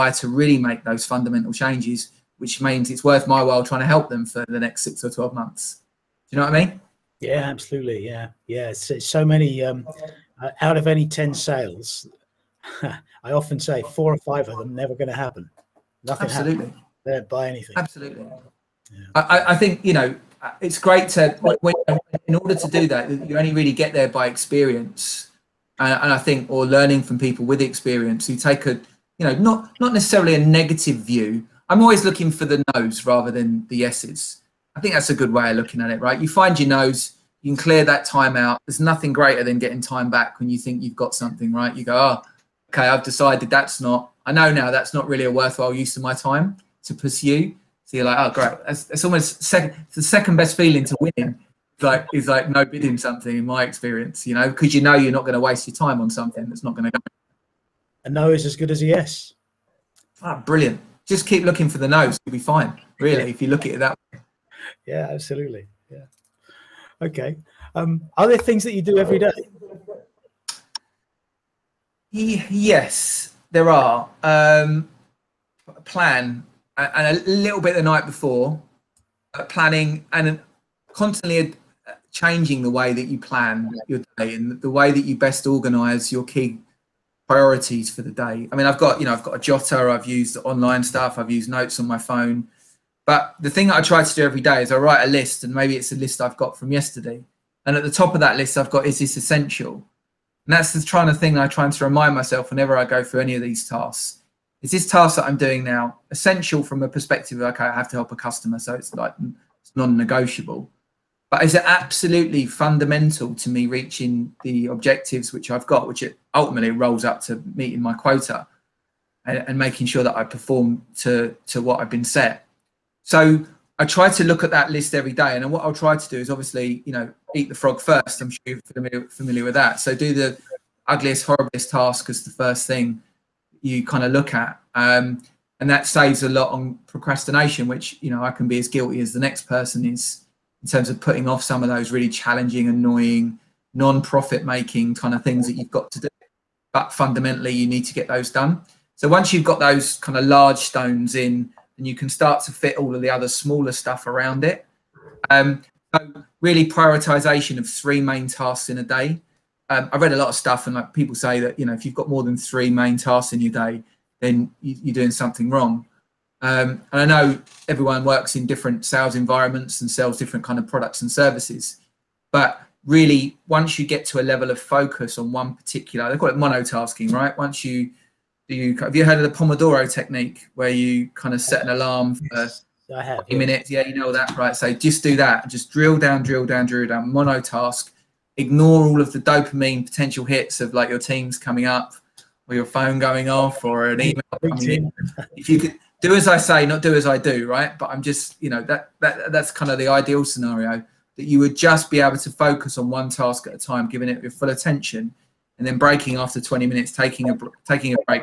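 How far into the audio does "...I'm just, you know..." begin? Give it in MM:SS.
03:17.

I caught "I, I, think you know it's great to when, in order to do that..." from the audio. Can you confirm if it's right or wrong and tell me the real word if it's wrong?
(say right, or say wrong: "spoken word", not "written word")
right.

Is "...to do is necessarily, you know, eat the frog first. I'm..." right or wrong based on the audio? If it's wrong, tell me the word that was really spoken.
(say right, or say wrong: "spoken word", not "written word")
wrong: "obviously", not "necessarily".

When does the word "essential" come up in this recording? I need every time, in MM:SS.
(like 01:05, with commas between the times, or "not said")
01:39, 01:46.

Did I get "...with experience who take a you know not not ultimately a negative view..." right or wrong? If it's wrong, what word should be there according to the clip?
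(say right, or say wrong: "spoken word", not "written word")
wrong: "necessarily", not "ultimately".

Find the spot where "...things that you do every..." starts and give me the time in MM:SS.
01:08.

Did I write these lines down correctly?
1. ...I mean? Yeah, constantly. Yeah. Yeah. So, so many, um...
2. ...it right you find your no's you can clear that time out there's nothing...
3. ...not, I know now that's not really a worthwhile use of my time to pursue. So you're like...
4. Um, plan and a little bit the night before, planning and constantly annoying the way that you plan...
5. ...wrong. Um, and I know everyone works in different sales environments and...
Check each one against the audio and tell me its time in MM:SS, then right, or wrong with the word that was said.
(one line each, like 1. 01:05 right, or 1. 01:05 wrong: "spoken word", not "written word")
1. 00:06 wrong: "absolutely", not "constantly"
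2. 00:35 right
3. 00:43 right
4. 01:14 wrong: "changing", not "annoying"
5. 02:45 right.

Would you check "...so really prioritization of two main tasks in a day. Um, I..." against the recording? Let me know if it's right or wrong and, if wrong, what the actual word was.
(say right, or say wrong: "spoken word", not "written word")
wrong: "three", not "two".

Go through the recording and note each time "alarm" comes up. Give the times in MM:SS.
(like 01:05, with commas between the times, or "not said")
03:01.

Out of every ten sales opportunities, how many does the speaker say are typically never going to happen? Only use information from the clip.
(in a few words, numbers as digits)
4 or 5.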